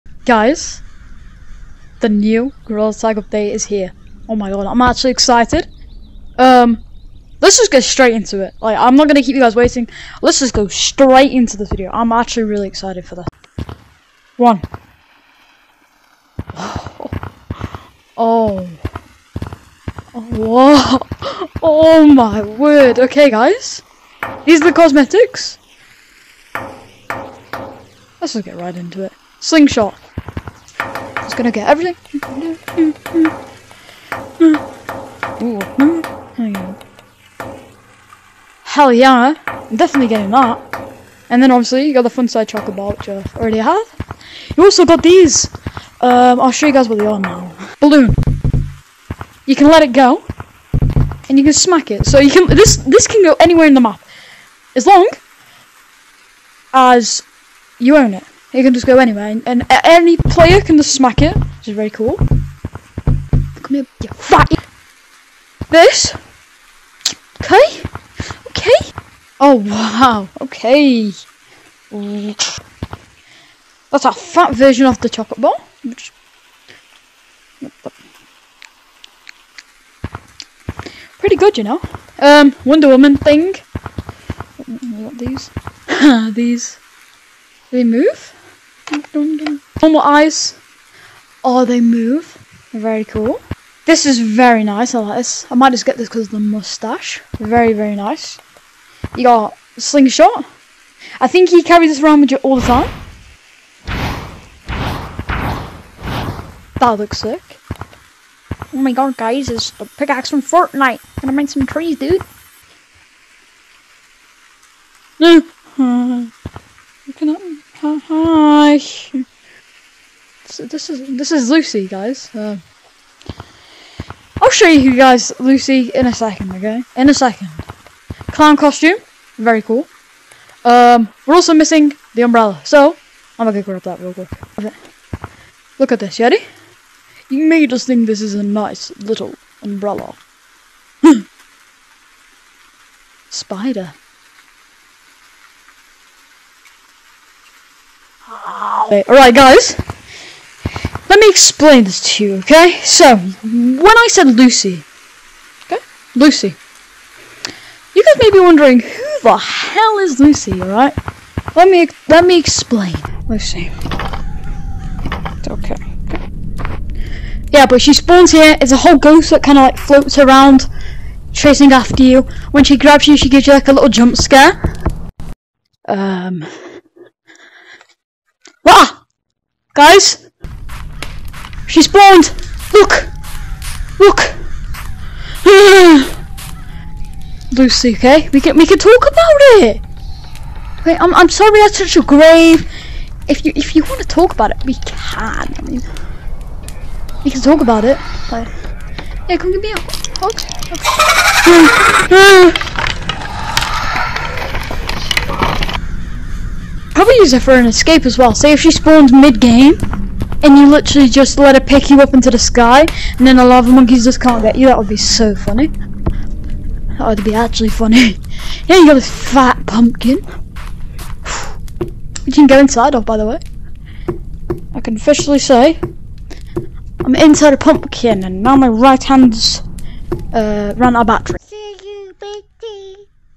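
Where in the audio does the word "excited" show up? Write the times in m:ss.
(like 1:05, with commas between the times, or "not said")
0:05, 0:12.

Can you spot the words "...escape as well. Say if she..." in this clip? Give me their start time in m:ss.
3:27.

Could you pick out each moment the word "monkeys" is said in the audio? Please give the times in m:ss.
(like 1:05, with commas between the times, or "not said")
3:33.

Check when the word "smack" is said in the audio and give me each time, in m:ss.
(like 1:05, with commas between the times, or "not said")
0:51, 1:00.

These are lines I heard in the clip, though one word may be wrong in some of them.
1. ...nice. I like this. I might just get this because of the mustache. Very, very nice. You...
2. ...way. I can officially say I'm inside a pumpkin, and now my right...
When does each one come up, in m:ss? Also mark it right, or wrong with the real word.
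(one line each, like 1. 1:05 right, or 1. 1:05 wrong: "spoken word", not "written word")
1. 1:34 right
2. 3:43 right.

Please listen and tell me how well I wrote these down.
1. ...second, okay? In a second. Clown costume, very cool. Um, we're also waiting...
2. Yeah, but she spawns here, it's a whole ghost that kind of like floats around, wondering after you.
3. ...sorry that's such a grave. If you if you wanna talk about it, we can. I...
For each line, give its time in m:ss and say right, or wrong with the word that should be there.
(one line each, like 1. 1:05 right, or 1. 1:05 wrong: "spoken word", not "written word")
1. 2:06 wrong: "missing", not "waiting"
2. 2:47 wrong: "chasing", not "wondering"
3. 3:11 right.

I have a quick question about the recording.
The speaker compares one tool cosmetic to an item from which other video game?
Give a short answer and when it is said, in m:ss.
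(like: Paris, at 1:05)
Fortnite, at 1:50.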